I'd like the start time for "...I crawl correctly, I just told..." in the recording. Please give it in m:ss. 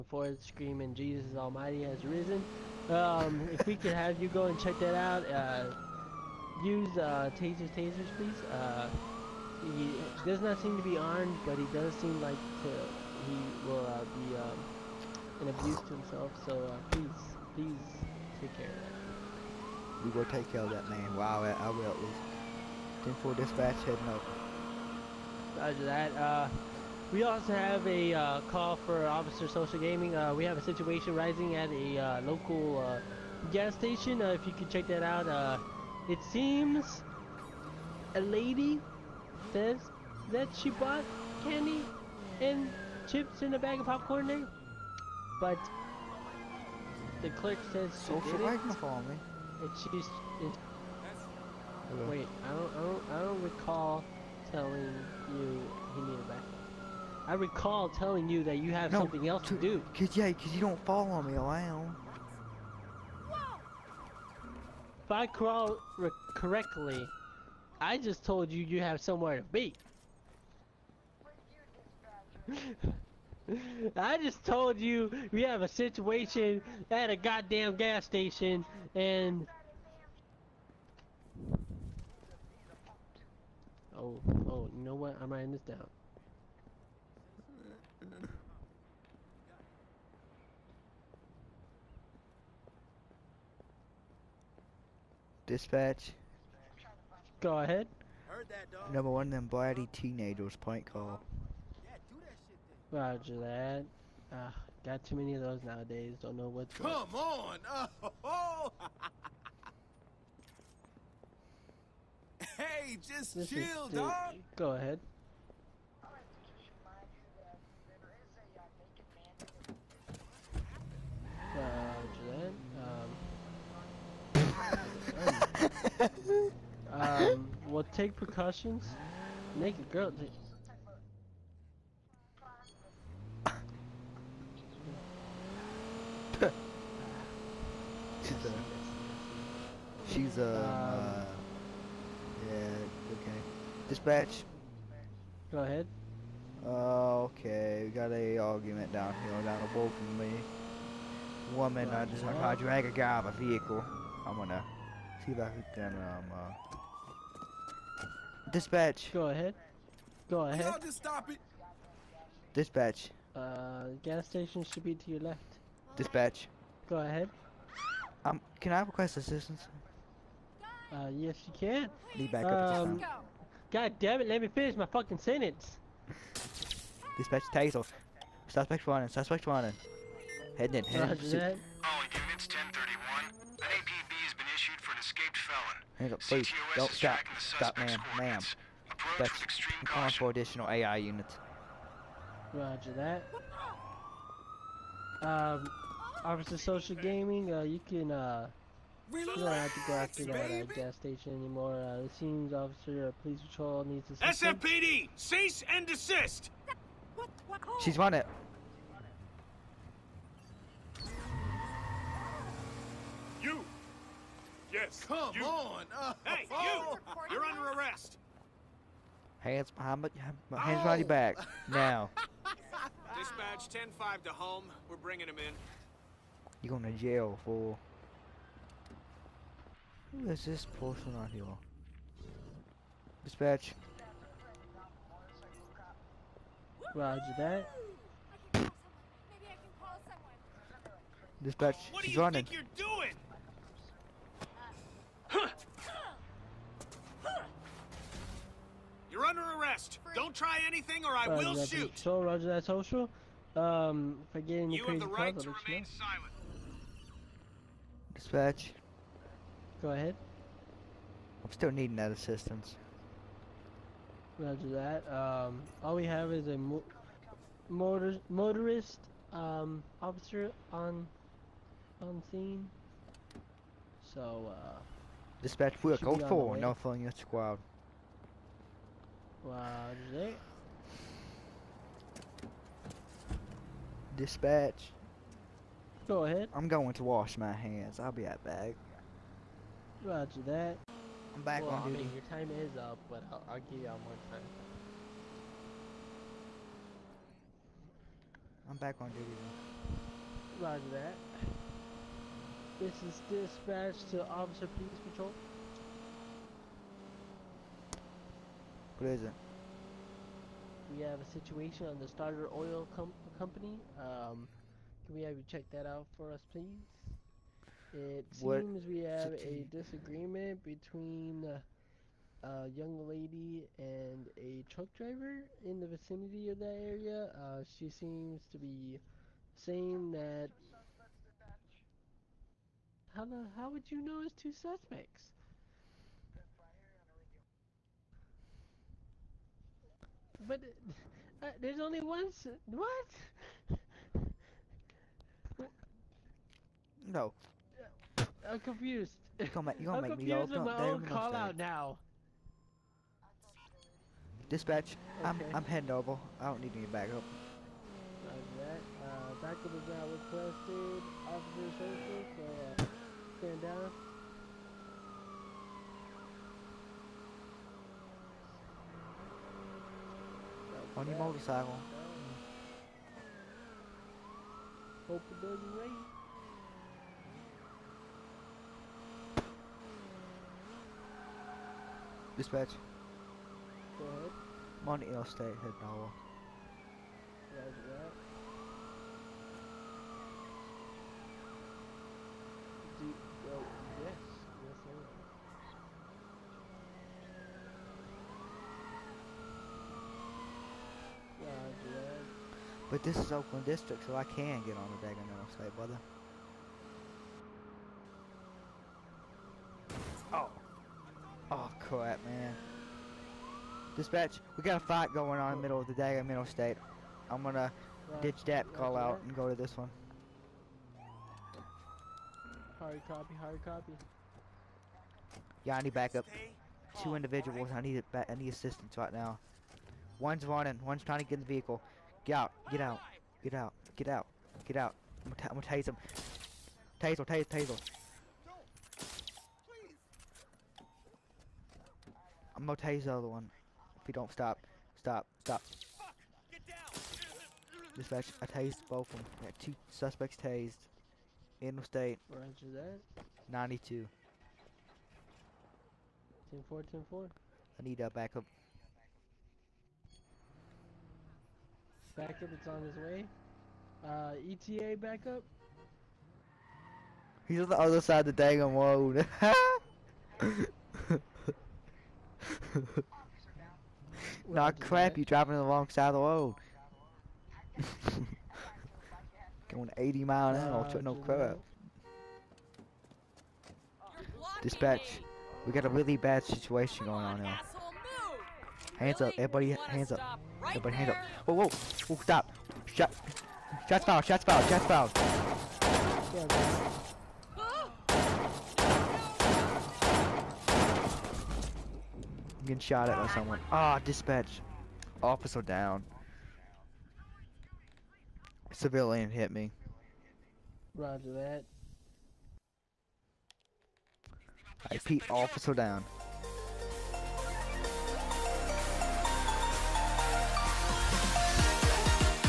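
1:05.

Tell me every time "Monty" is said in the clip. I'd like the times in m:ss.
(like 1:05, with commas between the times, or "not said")
6:24.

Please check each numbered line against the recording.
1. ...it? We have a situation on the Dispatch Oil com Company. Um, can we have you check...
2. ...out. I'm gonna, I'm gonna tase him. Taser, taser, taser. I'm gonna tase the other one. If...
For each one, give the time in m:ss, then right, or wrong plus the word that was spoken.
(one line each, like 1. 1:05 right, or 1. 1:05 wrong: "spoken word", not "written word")
1. 5:09 wrong: "Starter", not "Dispatch"
2. 7:14 right.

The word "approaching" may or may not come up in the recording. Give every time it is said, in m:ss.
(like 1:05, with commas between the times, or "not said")
not said.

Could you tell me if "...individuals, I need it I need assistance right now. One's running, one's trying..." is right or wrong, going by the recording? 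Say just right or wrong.
right.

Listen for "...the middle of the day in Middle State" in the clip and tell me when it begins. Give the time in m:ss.
6:55.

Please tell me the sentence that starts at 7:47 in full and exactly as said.
He's on the other side of the dang wall.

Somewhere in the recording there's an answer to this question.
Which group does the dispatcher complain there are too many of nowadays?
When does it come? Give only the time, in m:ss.
1:39.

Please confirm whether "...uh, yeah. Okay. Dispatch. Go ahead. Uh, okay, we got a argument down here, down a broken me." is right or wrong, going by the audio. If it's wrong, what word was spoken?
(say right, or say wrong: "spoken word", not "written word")
right.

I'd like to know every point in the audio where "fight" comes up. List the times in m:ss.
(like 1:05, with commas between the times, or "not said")
6:54.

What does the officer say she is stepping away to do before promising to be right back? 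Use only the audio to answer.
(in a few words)
Wash my hands.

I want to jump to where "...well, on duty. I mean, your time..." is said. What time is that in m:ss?
4:51.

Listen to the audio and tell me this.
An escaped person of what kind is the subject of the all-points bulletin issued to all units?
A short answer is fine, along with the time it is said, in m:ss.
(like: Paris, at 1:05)
Felon, at 3:05.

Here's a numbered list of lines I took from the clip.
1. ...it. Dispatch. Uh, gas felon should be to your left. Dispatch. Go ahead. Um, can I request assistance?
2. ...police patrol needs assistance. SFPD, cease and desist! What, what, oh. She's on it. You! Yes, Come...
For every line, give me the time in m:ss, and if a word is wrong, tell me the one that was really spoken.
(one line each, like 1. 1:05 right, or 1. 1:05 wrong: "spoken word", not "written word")
1. 2:41 wrong: "station", not "felon"
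2. 3:23 right.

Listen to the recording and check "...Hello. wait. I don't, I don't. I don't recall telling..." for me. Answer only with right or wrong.
right.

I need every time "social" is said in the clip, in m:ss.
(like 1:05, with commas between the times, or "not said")
0:29, 0:47, 3:16, 4:12, 6:01.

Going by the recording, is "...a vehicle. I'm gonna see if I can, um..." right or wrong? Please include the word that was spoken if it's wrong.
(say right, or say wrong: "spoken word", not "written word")
right.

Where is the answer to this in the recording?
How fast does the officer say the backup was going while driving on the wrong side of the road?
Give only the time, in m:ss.
7:59.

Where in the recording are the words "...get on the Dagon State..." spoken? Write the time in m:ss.
6:44.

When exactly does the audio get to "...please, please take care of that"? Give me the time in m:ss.
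0:16.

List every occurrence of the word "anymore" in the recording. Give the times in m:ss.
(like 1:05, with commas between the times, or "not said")
3:21.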